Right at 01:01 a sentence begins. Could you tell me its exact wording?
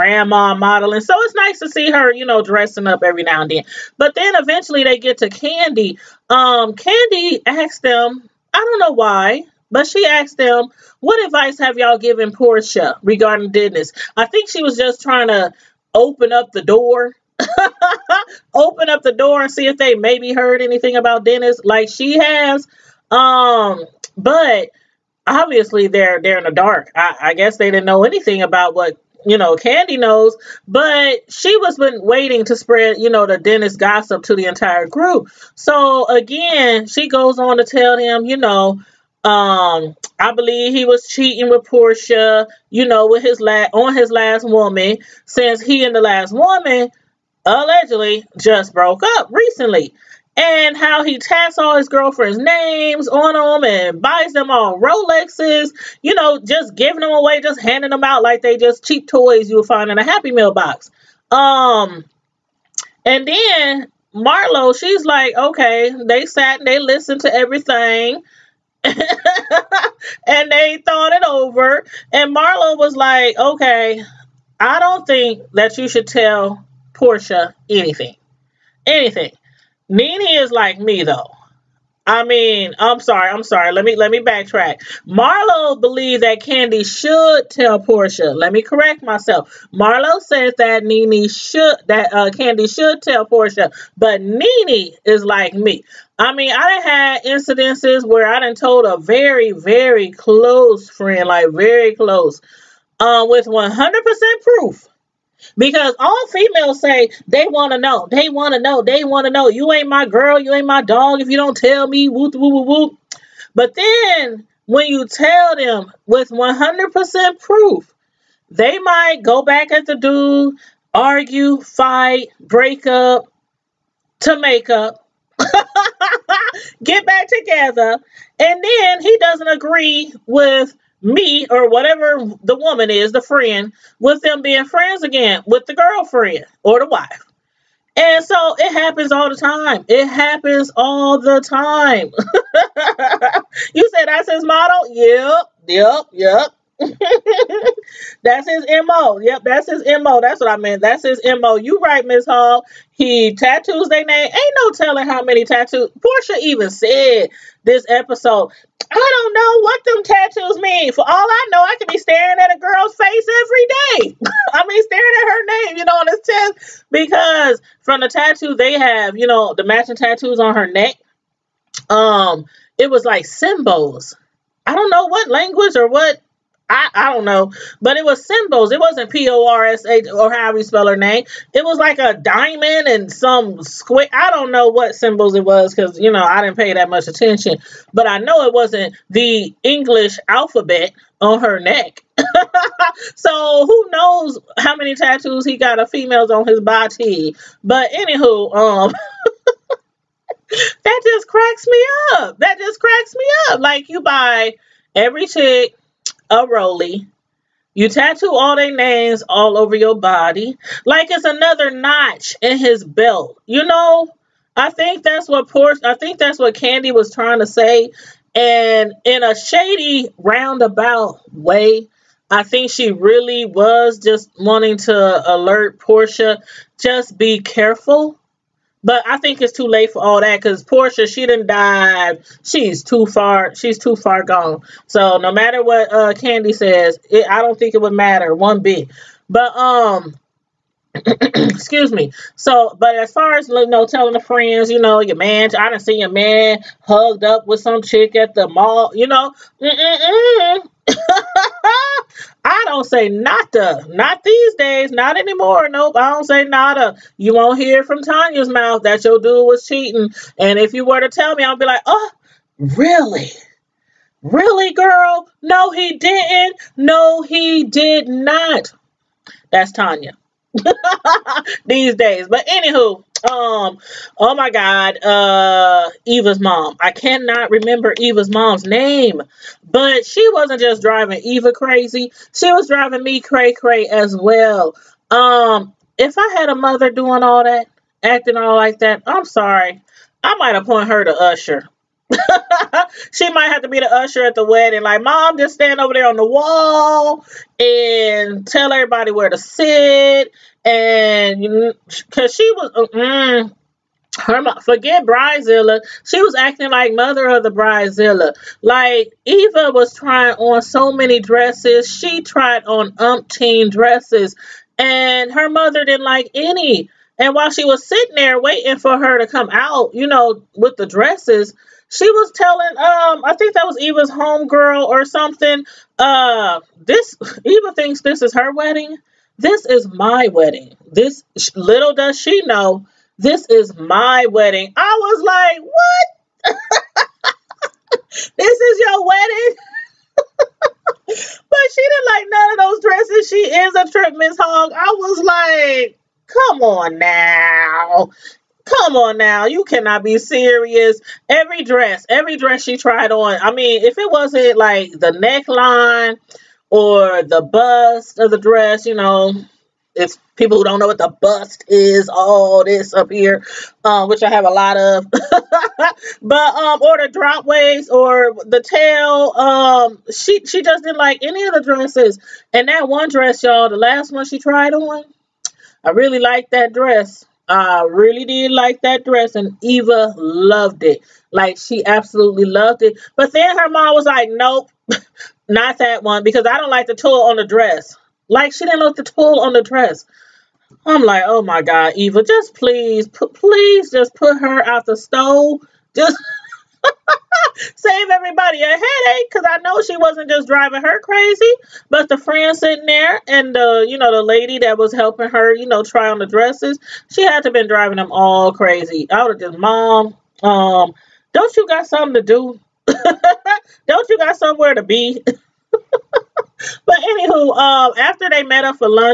Um, and then Marlo, she's like, okay, they sat and they listened to everything.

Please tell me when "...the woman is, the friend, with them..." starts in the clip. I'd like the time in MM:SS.
02:12.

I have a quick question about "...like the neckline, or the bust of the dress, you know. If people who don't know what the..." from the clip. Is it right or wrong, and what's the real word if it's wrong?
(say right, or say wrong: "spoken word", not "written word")
right.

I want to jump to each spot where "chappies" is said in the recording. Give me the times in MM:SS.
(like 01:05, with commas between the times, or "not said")
not said.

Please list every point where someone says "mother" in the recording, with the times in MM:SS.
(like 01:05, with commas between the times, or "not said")
04:46, 05:06, 05:15.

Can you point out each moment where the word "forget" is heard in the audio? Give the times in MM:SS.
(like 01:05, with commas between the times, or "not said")
05:04.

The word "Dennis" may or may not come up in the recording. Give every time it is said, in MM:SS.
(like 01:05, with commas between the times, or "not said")
00:21, 00:33.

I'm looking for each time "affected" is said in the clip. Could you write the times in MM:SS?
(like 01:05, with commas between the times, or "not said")
not said.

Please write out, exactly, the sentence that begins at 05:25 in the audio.
Uh this Eva thinks this is her wedding.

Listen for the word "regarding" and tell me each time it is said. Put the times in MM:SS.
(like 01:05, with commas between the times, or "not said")
00:13.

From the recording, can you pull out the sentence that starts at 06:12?
And that one dress, y'all, the last one she tried on, I really liked that dress.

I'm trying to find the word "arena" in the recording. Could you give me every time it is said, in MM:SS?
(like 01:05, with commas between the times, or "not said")
not said.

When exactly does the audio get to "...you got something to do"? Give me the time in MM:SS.
06:51.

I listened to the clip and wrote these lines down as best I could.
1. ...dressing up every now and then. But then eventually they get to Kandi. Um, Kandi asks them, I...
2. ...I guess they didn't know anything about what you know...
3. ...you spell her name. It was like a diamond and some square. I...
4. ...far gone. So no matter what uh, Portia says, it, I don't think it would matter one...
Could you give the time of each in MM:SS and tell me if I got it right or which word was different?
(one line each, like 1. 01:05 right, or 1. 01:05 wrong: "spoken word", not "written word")
1. 00:02 right
2. 00:27 right
3. 03:00 right
4. 03:53 wrong: "Candy", not "Portia".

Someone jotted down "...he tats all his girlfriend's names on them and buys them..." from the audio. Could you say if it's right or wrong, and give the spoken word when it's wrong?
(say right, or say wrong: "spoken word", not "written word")
right.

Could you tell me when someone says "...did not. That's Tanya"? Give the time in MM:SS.
04:27.